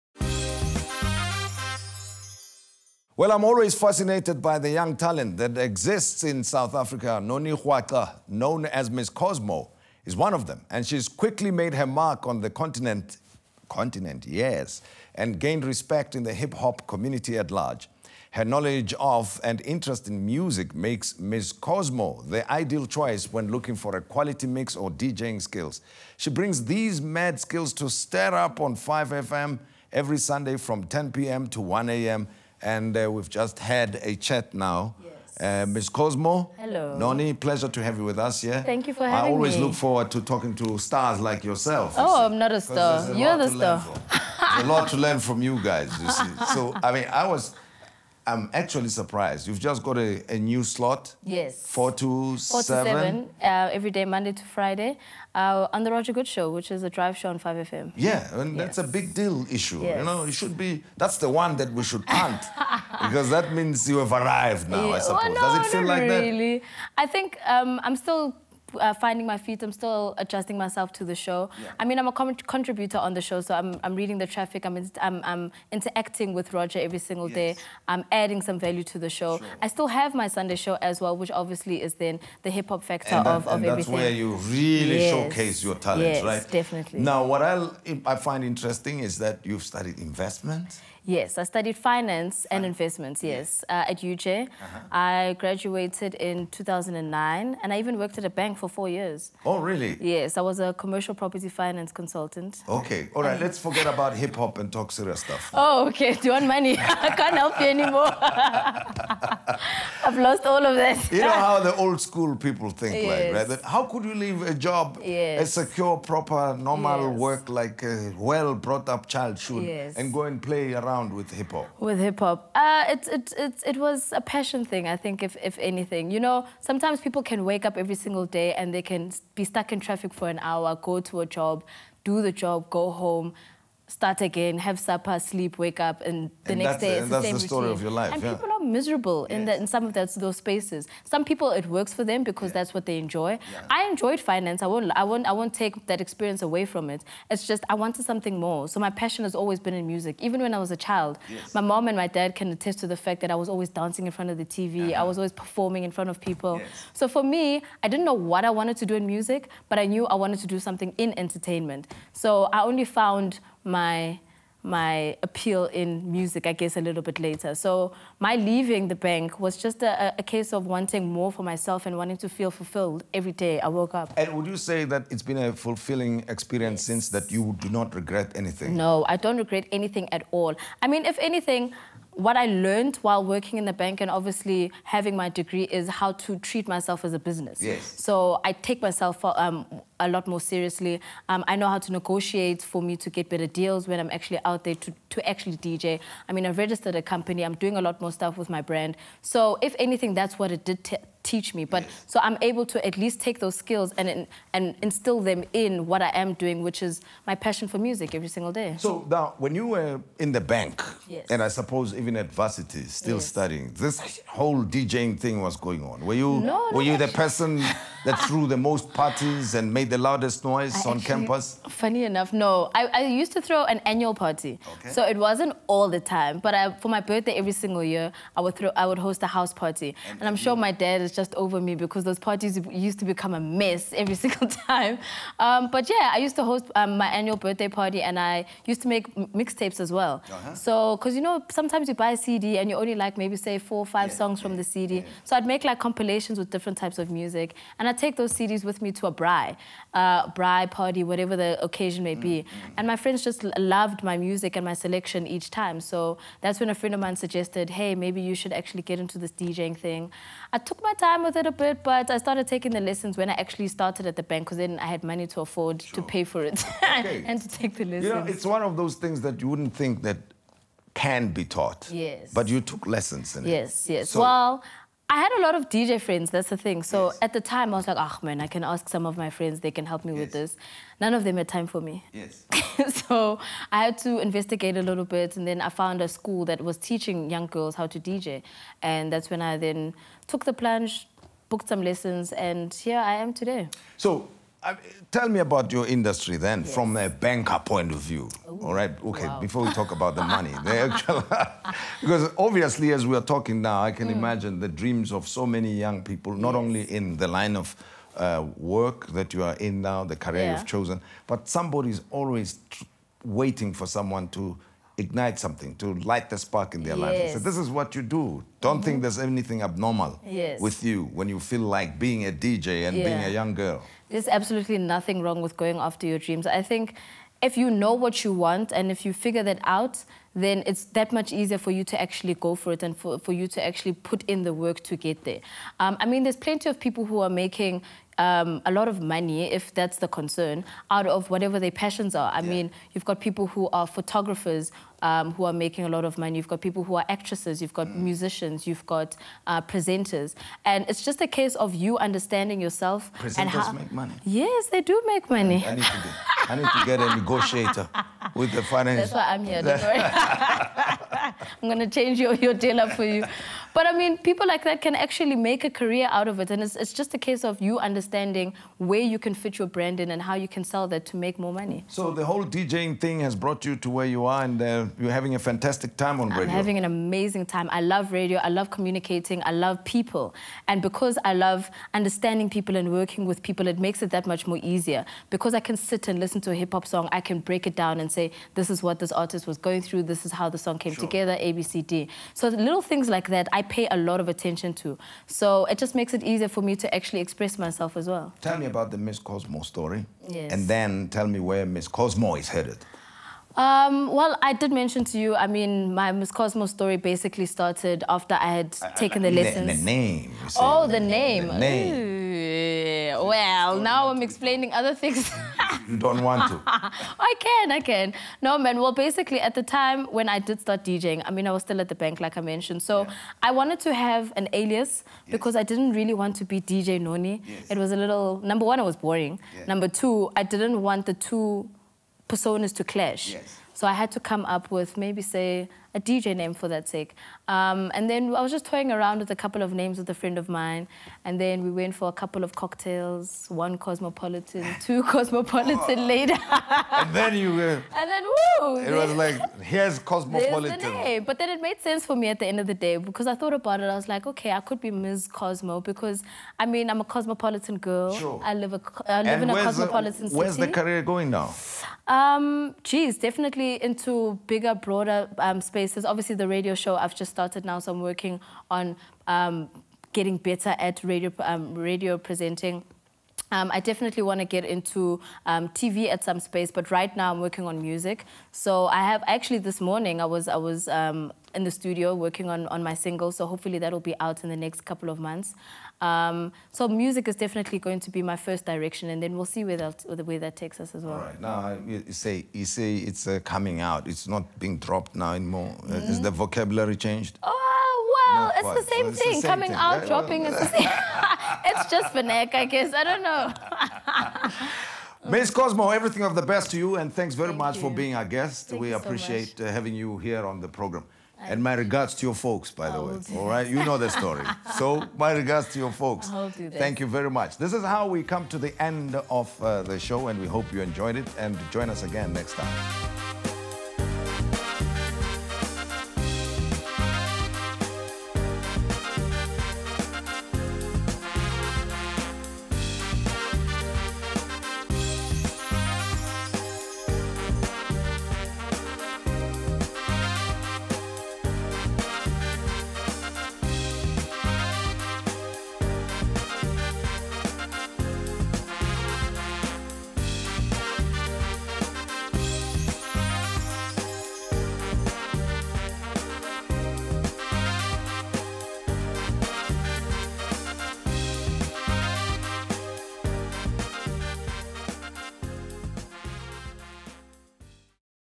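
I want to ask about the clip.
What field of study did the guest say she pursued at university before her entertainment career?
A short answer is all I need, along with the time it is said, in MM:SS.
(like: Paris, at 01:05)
Finance and investments, at 01:31.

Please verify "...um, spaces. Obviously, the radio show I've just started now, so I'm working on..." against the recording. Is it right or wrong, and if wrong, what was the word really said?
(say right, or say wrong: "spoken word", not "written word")
right.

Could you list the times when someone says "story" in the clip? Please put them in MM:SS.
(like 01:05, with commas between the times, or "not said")
02:17, 06:39, 06:46, 08:34.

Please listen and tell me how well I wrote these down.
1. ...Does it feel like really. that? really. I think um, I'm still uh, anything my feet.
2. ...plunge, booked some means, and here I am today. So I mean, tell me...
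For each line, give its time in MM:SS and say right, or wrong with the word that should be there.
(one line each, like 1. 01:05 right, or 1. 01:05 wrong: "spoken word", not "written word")
1. 01:05 wrong: "finding", not "anything"
2. 04:50 wrong: "lessons", not "means".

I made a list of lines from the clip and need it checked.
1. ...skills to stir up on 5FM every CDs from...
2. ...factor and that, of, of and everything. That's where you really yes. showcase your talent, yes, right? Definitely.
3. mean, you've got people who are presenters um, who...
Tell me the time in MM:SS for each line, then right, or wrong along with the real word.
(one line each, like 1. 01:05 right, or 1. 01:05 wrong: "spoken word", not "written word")
1. 00:27 wrong: "Sunday", not "CDs"
2. 01:22 right
3. 05:42 wrong: "photographers", not "presenters".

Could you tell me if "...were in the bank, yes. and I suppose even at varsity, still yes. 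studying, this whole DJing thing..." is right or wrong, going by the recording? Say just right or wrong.
right.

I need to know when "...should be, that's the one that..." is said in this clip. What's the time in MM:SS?
01:00.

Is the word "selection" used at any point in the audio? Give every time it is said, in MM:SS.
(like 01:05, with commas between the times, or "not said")
04:14.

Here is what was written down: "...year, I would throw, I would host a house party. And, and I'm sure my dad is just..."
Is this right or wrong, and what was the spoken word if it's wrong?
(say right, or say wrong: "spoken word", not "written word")
right.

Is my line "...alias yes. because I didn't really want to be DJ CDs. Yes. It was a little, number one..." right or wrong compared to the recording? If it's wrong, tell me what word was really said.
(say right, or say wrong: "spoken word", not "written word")
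wrong: "Noni", not "CDs".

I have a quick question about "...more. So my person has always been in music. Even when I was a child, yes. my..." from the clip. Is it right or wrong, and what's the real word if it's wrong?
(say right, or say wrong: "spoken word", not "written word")
wrong: "passion", not "person".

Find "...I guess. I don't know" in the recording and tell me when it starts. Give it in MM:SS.
08:22.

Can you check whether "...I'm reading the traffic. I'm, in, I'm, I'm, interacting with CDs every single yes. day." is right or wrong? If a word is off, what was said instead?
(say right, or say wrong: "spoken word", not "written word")
wrong: "Roger", not "CDs".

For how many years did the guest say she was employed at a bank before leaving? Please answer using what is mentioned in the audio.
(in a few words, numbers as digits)
4 years.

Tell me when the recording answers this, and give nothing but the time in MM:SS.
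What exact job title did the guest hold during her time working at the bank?
01:40.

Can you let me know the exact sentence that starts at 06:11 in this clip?
So the whole DJing thing has brought you to where you are and uh, you're having a fantastic time on I'm radio.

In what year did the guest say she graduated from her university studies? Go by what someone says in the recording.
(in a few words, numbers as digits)
2009.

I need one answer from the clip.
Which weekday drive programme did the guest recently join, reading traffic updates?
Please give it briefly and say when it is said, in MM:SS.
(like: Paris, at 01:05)
Roger Goode Show, at 00:55.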